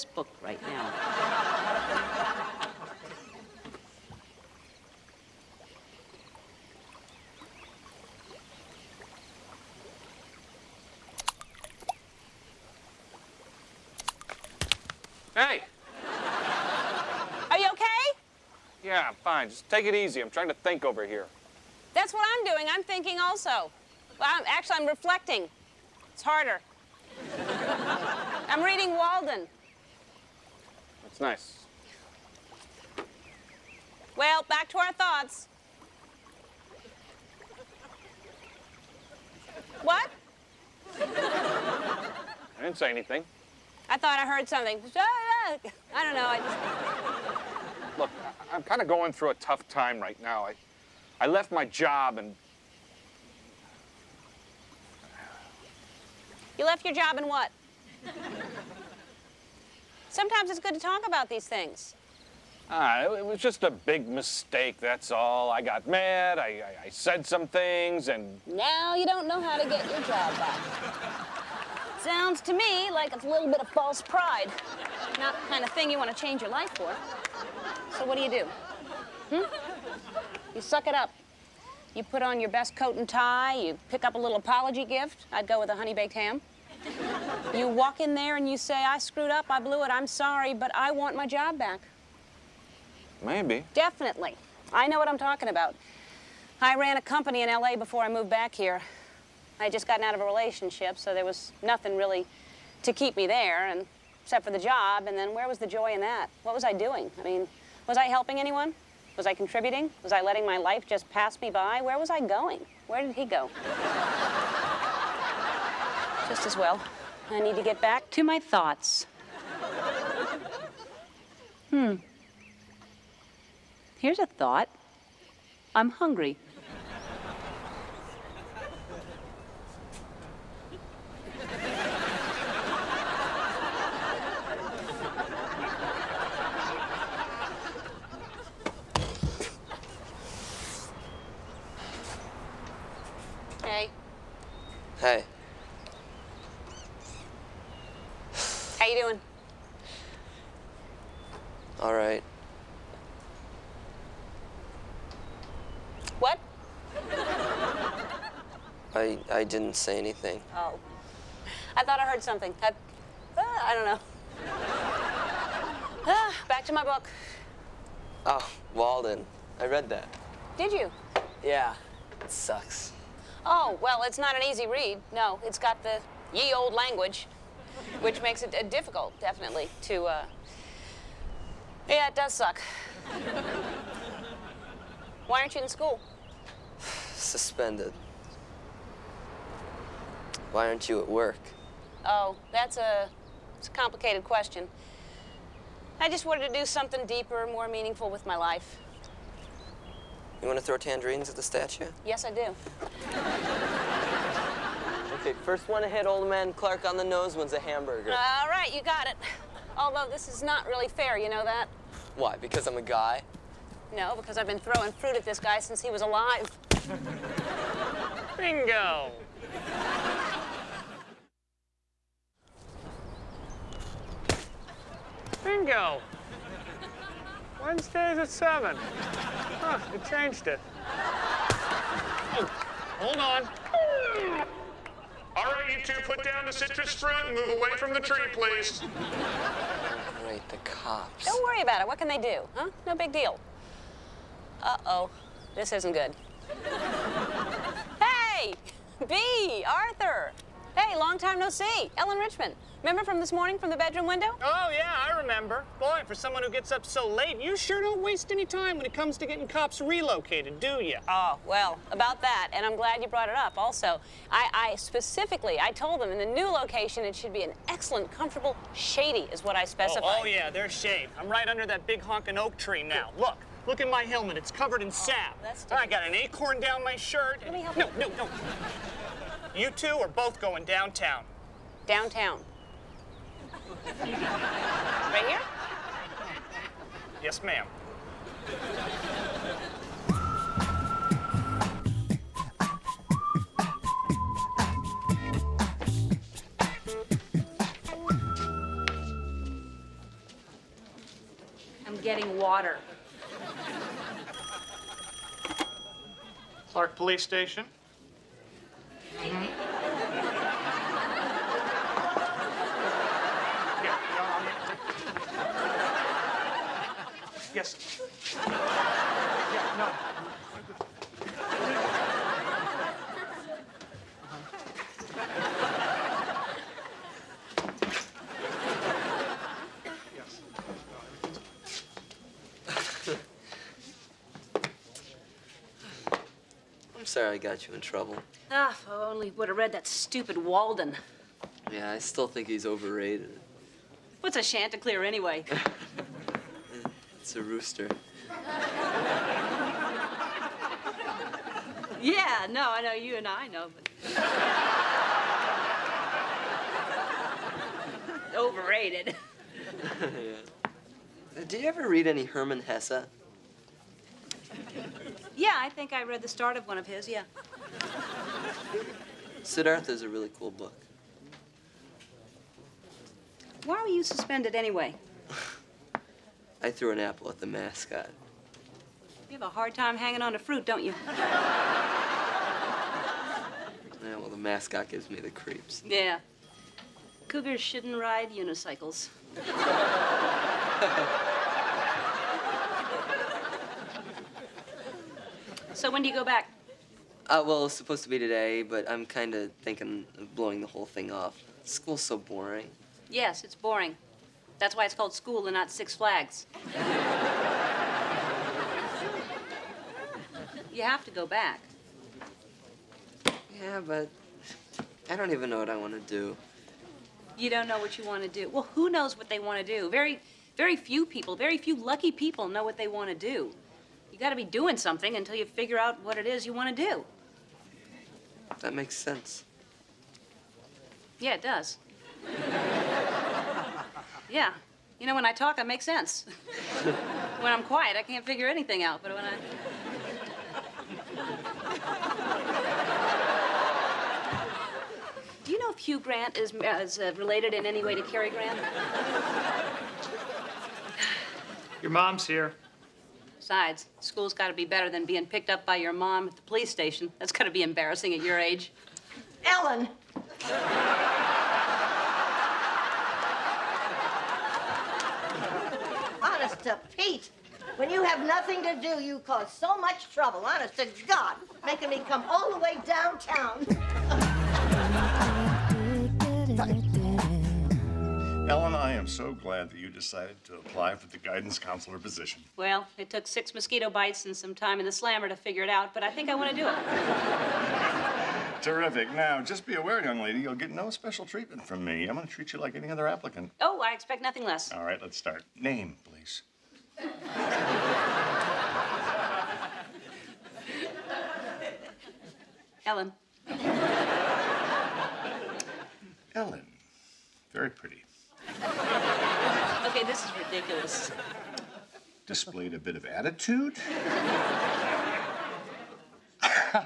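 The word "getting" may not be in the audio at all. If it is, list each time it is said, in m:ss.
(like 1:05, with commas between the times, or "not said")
4:19, 5:02.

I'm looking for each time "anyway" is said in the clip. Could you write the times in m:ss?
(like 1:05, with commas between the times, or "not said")
5:45, 6:14.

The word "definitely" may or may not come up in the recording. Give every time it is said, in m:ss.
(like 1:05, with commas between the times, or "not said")
1:33, 2:59.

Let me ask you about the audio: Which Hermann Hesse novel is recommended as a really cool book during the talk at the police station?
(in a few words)
Siddhartha.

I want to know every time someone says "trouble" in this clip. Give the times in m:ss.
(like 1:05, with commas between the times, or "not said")
5:37, 7:50.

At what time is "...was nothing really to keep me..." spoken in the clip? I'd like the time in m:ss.
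1:41.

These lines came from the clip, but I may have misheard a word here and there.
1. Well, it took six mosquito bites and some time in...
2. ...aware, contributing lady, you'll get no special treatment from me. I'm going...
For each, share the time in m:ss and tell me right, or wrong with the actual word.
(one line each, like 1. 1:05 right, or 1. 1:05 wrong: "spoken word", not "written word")
1. 8:02 right
2. 8:09 wrong: "young", not "contributing".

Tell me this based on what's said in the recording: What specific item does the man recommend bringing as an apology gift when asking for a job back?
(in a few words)
honey baked ham.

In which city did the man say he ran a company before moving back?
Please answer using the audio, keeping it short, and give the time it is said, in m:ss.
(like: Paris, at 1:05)
LA, at 1:37.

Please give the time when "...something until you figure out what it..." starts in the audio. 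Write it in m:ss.
7:04.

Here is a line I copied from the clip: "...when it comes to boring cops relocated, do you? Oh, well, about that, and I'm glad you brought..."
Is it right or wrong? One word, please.
wrong.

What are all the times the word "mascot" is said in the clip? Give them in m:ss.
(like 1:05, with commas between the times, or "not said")
6:17, 6:24.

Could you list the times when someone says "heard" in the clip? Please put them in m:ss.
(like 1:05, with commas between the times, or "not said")
0:44, 2:42.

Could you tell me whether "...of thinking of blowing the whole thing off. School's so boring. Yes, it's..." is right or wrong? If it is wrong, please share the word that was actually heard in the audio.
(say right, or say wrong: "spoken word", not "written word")
right.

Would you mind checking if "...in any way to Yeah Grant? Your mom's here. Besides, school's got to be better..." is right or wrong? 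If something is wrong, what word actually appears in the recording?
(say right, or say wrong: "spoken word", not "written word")
wrong: "Cary", not "Yeah".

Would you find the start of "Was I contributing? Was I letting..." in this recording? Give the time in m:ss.
1:49.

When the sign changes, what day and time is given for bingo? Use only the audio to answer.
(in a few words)
Wednesdays at 7.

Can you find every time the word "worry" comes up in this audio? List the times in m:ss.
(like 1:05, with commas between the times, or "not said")
4:01.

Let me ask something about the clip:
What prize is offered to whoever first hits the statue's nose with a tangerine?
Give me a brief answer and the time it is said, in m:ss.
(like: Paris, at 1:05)
a hamburger, at 3:27.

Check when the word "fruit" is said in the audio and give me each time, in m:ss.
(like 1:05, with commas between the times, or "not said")
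3:34, 3:56, 6:20.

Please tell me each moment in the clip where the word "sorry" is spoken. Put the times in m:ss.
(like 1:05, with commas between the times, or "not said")
1:30, 5:37.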